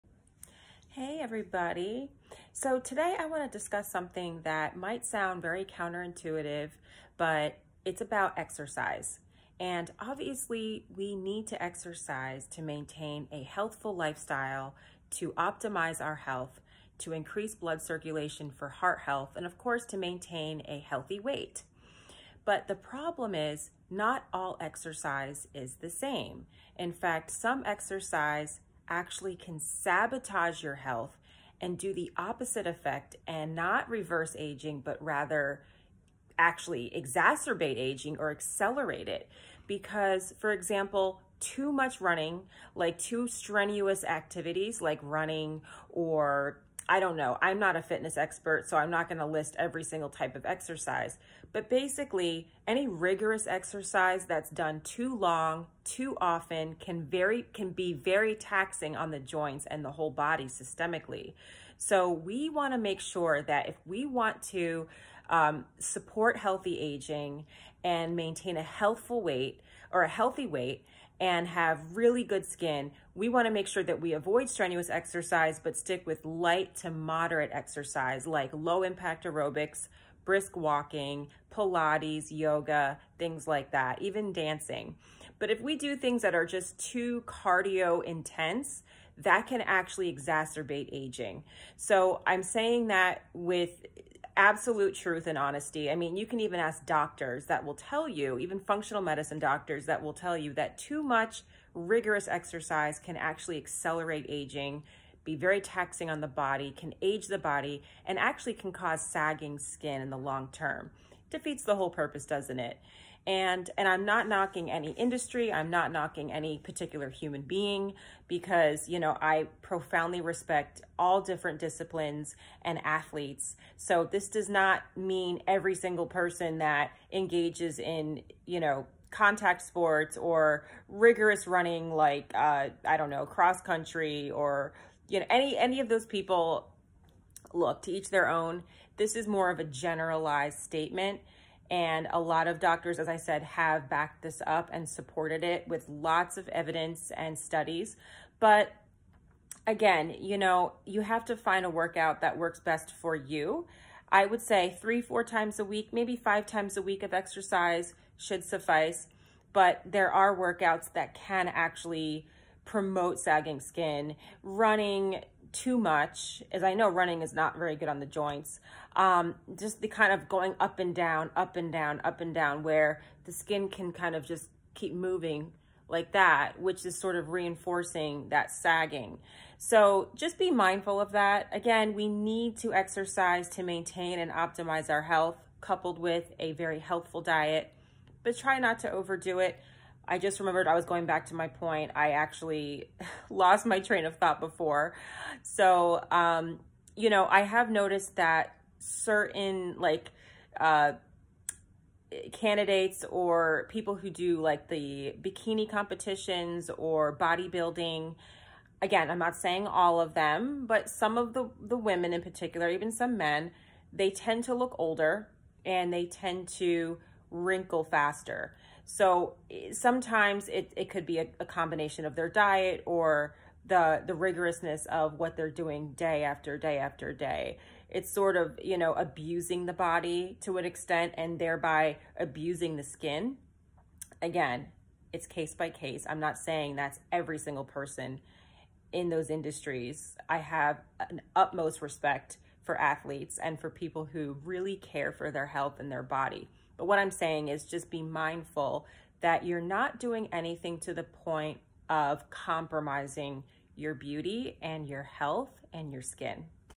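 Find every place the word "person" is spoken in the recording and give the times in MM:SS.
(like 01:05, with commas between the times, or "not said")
02:06, 03:57.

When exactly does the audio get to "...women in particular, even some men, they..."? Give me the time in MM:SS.
03:31.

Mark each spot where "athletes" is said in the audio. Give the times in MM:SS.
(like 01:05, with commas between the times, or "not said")
02:02, 04:02.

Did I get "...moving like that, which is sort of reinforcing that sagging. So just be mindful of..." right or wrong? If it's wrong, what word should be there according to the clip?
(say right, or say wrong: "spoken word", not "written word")
right.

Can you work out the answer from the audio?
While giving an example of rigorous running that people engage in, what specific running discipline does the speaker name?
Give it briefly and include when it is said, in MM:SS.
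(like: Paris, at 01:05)
cross country, at 02:13.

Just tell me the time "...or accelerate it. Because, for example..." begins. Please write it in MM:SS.
00:38.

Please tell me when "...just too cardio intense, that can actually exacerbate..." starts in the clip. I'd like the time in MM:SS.
01:26.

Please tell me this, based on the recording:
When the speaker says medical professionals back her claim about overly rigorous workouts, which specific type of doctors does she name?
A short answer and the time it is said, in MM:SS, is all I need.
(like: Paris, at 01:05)
functional medicine doctors, at 01:38.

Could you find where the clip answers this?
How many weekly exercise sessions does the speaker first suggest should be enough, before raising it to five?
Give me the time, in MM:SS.
02:34.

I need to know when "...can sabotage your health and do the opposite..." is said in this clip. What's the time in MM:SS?
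00:29.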